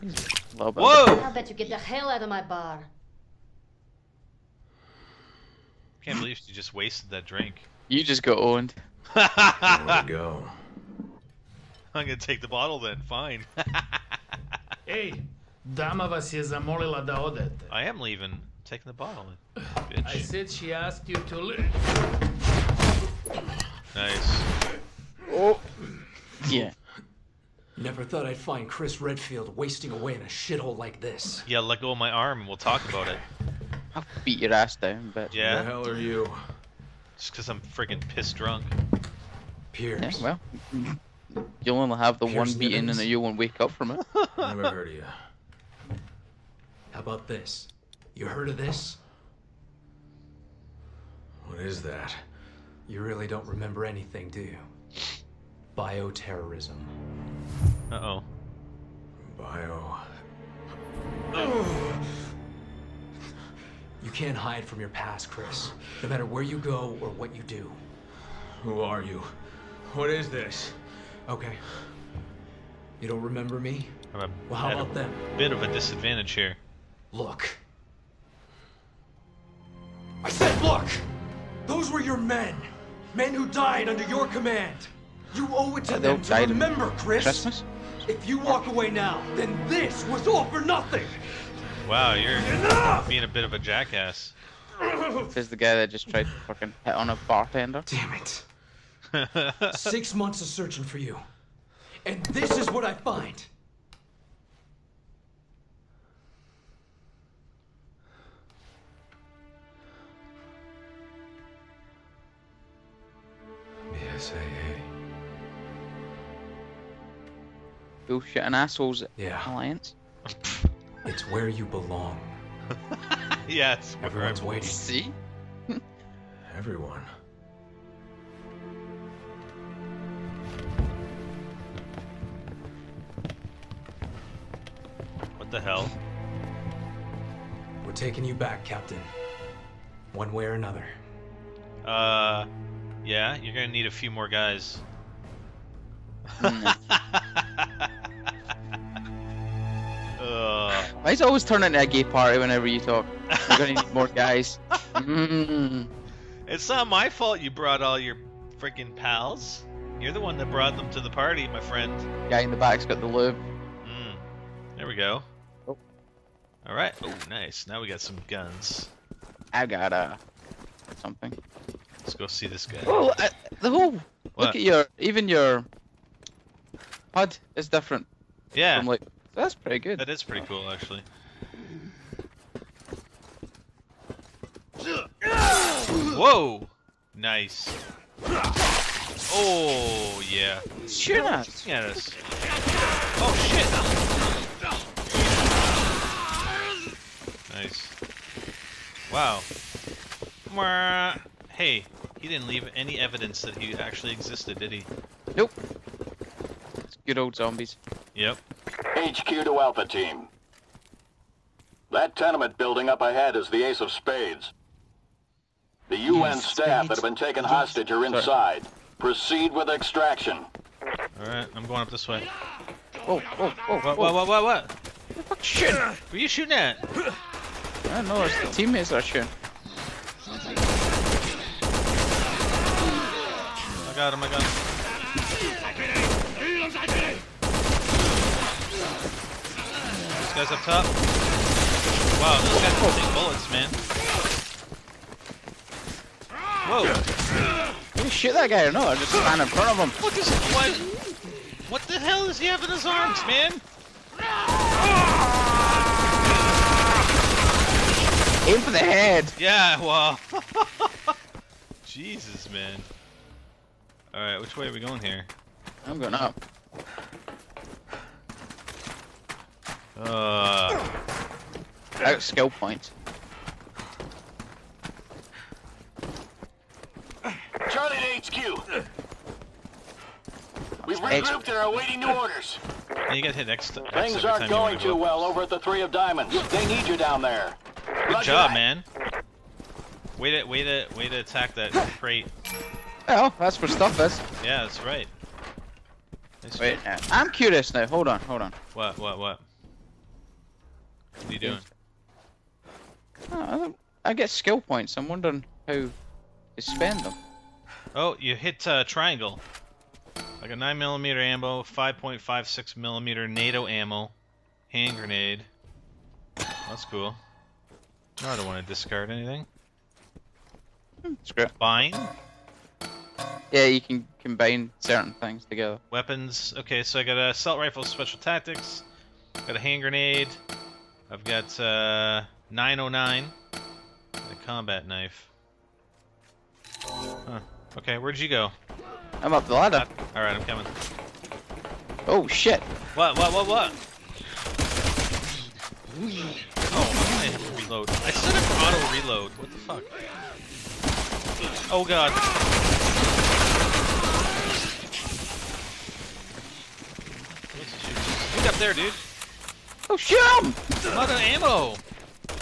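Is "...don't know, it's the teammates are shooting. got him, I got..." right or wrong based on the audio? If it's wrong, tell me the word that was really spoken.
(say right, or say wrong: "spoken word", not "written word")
right.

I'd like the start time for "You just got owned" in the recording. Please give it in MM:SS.
00:07.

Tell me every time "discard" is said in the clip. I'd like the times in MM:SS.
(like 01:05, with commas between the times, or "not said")
05:18.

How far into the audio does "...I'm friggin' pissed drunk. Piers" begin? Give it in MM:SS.
00:37.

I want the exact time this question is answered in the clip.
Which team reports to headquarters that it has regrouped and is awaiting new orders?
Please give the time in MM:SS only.
04:37.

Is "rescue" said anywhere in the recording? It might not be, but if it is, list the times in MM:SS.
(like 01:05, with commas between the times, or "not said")
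not said.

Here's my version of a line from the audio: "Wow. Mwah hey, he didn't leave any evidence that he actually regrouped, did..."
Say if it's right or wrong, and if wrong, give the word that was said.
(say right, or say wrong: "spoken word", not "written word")
wrong: "existed", not "regrouped".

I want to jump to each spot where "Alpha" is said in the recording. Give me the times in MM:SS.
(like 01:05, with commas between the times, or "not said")
03:29.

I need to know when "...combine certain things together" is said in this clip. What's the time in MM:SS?
05:24.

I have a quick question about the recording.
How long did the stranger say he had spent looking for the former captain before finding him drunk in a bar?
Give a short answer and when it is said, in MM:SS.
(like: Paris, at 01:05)
Six months, at 01:39.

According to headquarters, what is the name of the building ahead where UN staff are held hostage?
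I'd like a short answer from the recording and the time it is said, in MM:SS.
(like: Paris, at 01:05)
Ace of Spades, at 03:33.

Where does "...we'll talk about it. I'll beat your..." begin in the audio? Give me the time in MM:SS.
00:32.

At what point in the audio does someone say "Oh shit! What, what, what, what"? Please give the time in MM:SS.
05:42.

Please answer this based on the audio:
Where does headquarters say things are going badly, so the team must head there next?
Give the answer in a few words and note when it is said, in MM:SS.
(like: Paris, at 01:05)
Three of Diamonds, at 04:45.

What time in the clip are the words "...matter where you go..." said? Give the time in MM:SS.
01:06.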